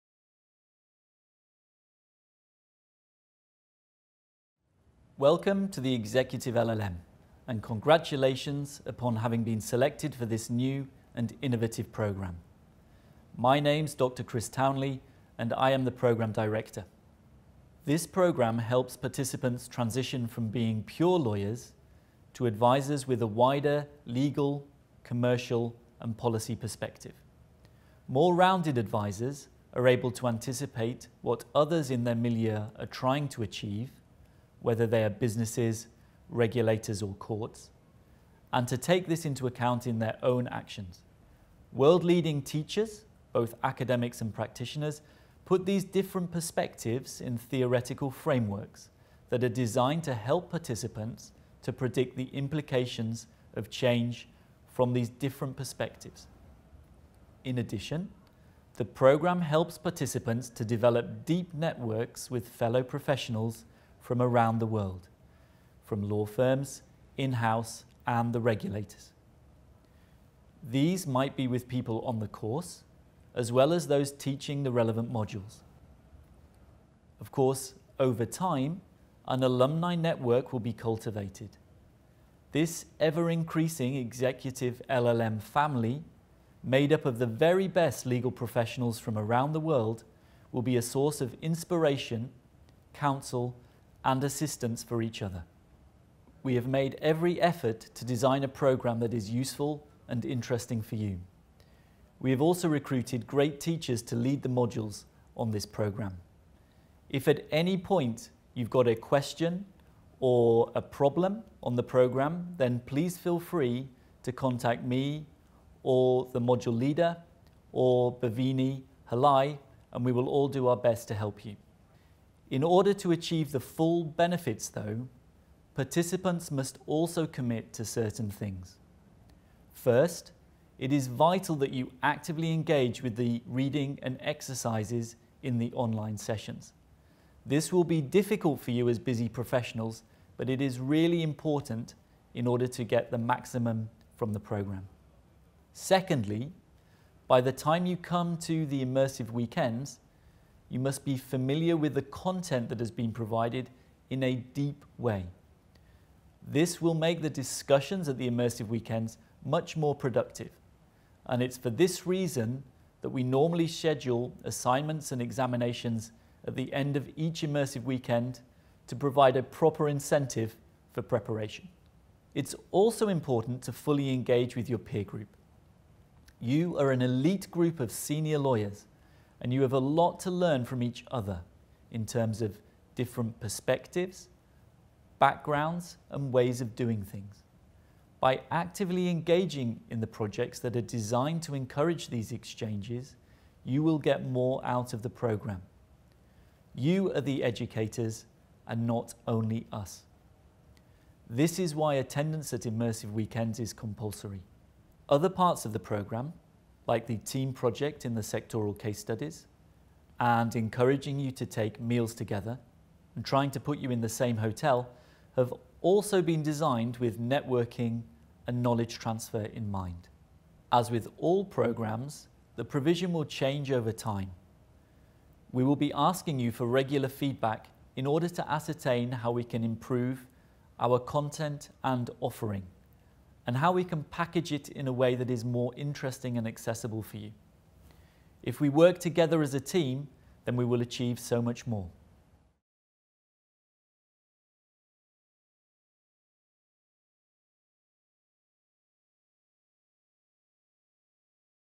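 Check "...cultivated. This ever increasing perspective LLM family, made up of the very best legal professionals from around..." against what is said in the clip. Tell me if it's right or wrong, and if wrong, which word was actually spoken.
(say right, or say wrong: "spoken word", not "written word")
wrong: "executive", not "perspective".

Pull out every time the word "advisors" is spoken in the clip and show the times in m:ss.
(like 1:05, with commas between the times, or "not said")
0:22, 0:28.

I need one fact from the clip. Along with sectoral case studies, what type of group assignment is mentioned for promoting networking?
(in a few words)
team project.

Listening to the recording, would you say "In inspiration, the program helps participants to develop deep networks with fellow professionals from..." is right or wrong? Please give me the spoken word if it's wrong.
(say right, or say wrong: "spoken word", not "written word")
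wrong: "addition", not "inspiration".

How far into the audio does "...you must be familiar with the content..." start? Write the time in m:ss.
2:30.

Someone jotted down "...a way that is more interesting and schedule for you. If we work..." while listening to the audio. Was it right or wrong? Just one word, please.
wrong.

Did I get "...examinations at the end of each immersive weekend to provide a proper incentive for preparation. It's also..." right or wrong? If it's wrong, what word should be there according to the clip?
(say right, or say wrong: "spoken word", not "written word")
right.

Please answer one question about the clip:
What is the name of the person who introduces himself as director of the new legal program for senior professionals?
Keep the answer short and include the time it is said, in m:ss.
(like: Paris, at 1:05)
Dr. Chris Townley, at 0:13.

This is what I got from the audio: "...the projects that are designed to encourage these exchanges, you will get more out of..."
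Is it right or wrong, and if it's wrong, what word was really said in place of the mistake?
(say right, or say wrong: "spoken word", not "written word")
right.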